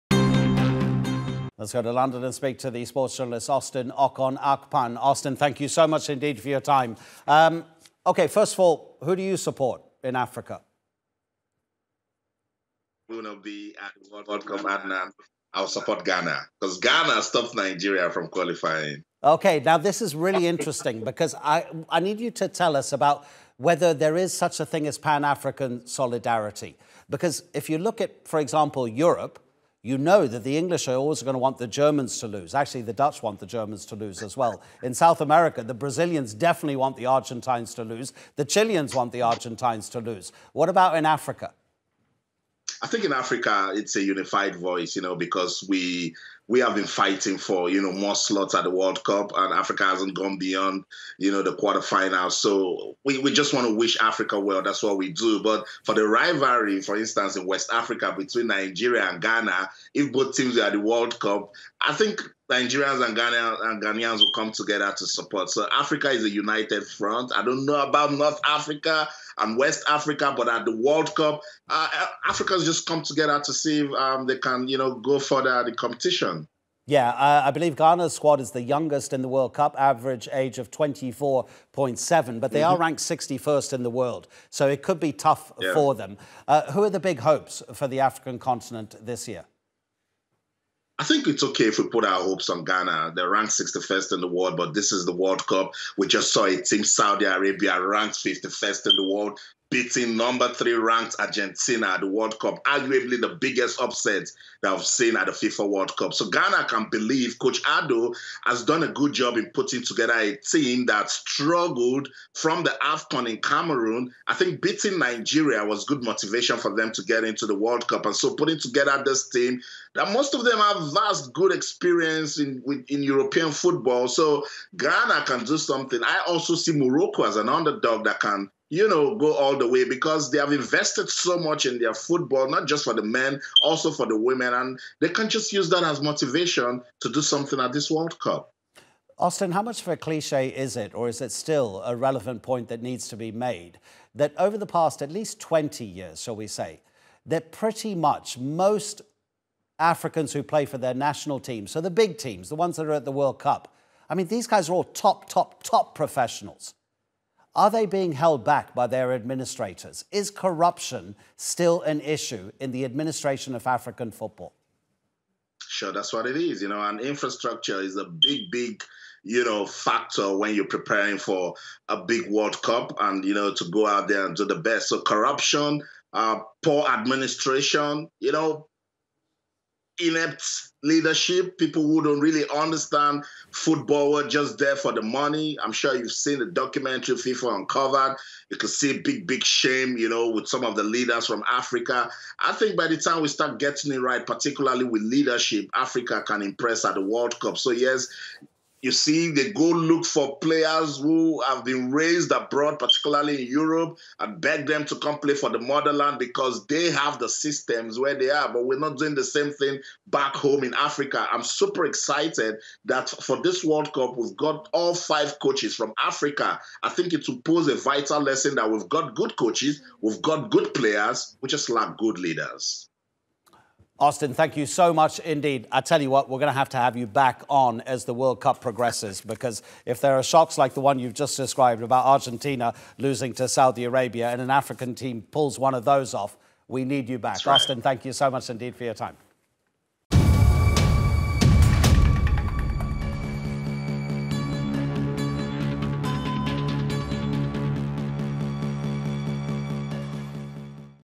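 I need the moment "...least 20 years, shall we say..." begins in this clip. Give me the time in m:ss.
2:25.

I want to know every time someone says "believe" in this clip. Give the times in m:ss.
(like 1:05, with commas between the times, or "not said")
1:17, 1:46.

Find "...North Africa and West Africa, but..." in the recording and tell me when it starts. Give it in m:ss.
1:08.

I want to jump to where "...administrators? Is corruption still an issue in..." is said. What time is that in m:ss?
2:39.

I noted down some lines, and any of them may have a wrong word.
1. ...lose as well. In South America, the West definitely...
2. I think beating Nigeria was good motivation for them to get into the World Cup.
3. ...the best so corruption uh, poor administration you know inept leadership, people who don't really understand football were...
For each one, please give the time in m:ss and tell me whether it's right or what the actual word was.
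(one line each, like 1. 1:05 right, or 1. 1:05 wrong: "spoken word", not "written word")
1. 0:33 wrong: "Brazilians", not "West"
2. 1:54 right
3. 2:54 right.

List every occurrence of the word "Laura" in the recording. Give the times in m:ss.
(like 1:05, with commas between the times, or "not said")
not said.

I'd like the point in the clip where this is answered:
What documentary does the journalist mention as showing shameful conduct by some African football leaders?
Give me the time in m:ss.
3:07.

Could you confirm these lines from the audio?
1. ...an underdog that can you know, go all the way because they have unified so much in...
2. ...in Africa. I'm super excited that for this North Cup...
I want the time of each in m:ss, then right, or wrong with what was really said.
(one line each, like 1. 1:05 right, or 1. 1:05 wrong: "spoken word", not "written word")
1. 2:07 wrong: "invested", not "unified"
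2. 3:30 wrong: "World", not "North".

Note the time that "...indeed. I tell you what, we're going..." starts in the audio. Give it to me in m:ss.
3:45.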